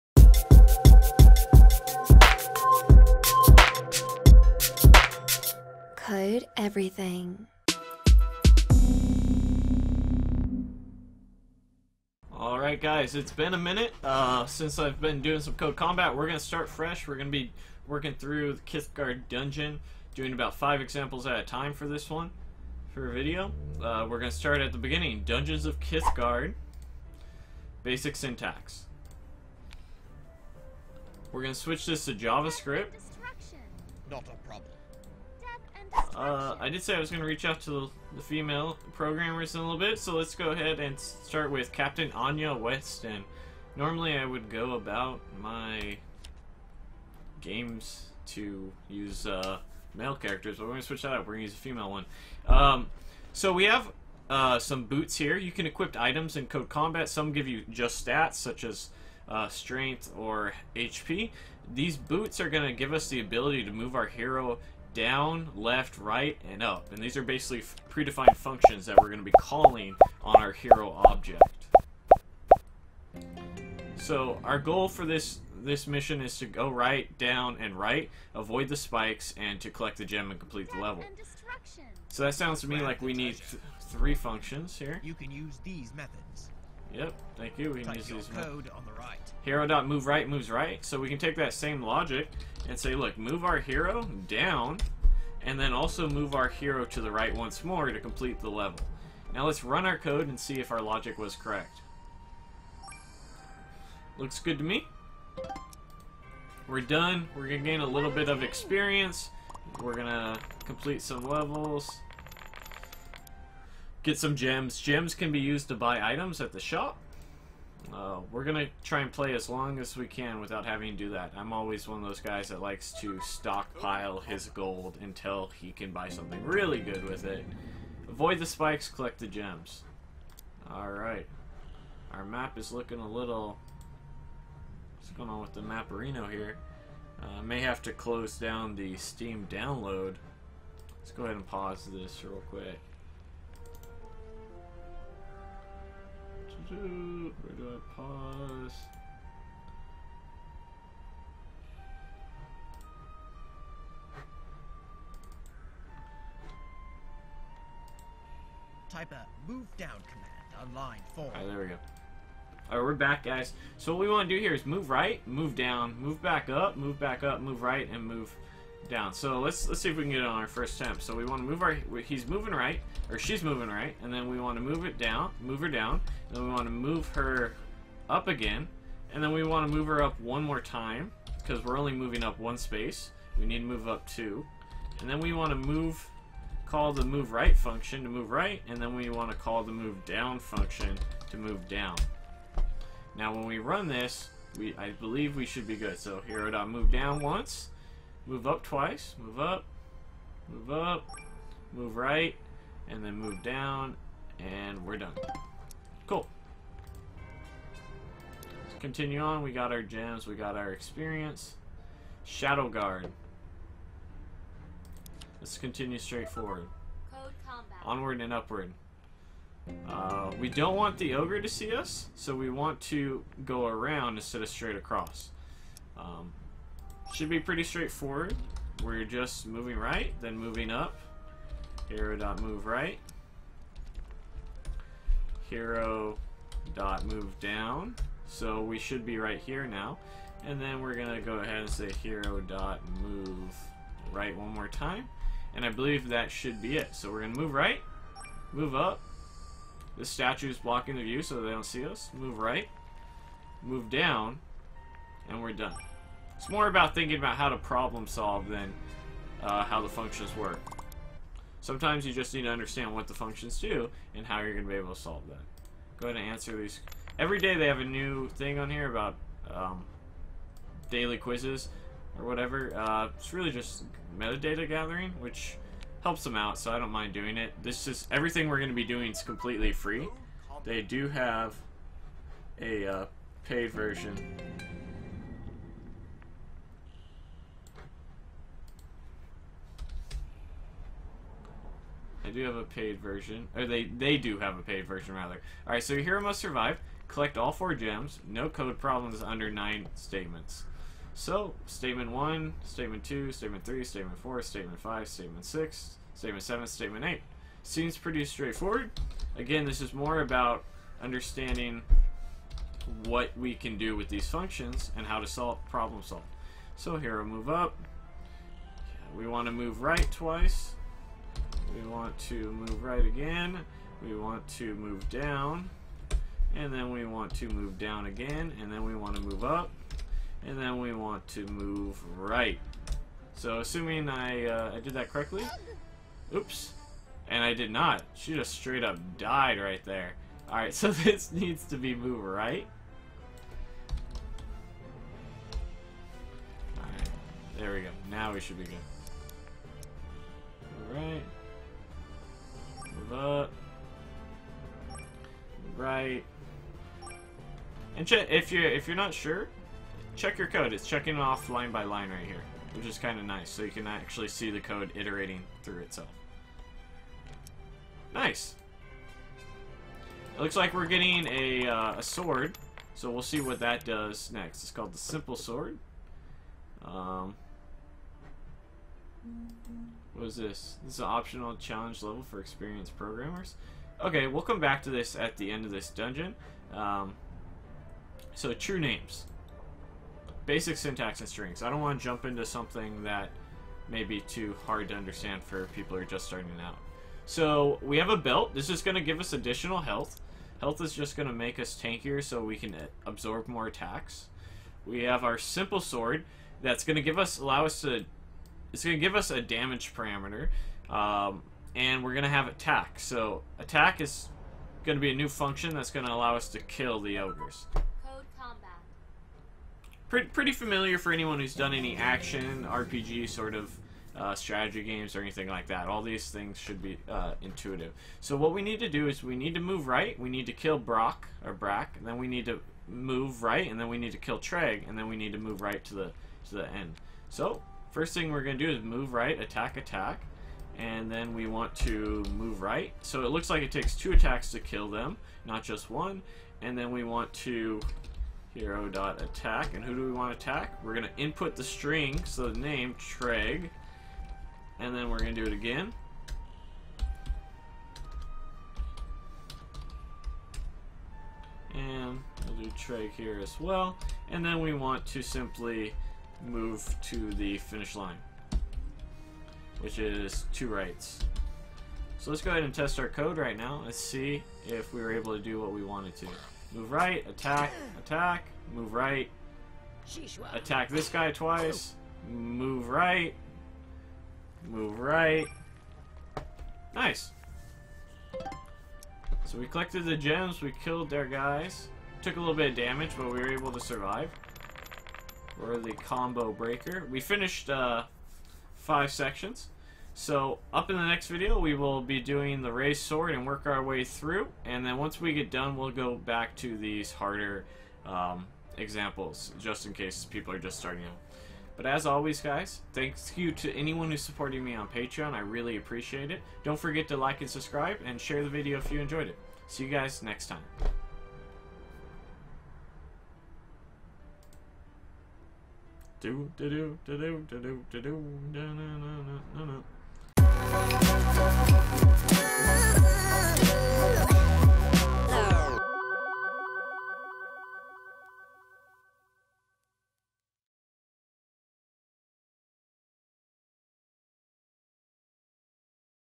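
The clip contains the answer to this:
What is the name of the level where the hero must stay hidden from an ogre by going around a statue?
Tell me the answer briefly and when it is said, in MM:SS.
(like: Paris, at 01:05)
Shadow Guard, at 03:32.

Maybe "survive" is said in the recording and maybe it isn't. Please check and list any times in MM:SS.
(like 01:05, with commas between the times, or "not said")
04:56, 08:13.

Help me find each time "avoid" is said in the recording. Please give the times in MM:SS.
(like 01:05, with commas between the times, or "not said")
01:18, 02:08.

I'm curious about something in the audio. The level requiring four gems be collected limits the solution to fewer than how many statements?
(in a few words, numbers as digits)
9.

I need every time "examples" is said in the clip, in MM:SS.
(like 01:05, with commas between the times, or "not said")
00:20, 08:28.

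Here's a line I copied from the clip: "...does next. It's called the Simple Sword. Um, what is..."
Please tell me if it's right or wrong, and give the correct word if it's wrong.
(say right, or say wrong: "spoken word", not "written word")
right.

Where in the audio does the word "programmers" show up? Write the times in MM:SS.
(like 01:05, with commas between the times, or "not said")
00:38, 06:22.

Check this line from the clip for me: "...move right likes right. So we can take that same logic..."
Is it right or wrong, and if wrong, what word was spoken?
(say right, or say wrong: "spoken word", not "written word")
wrong: "moves", not "likes".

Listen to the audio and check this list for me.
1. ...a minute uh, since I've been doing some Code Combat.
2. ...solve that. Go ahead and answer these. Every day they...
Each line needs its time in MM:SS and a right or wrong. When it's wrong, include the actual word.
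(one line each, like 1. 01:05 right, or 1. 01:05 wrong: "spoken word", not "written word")
1. 00:13 right
2. 04:24 right.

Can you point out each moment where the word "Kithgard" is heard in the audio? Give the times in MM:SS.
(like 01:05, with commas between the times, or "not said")
00:18, 00:25.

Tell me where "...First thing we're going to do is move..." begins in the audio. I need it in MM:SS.
07:17.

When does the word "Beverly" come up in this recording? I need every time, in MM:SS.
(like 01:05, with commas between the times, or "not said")
not said.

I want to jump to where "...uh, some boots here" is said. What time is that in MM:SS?
00:54.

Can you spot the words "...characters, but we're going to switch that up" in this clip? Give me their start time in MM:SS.
00:50.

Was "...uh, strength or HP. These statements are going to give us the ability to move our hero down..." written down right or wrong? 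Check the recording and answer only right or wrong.
wrong.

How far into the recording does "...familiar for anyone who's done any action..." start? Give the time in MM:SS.
07:00.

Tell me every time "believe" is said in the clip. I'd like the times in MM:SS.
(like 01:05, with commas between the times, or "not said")
03:14, 04:05.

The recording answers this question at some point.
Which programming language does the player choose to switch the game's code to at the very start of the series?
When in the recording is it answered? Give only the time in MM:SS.
00:32.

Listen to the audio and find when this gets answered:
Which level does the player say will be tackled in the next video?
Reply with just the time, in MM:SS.
08:22.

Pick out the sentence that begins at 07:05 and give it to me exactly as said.
All these things should be uh, intuitive.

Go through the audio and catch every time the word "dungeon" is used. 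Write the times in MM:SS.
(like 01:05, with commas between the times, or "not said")
00:19, 00:25, 06:25.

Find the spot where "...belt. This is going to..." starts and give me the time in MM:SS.
06:38.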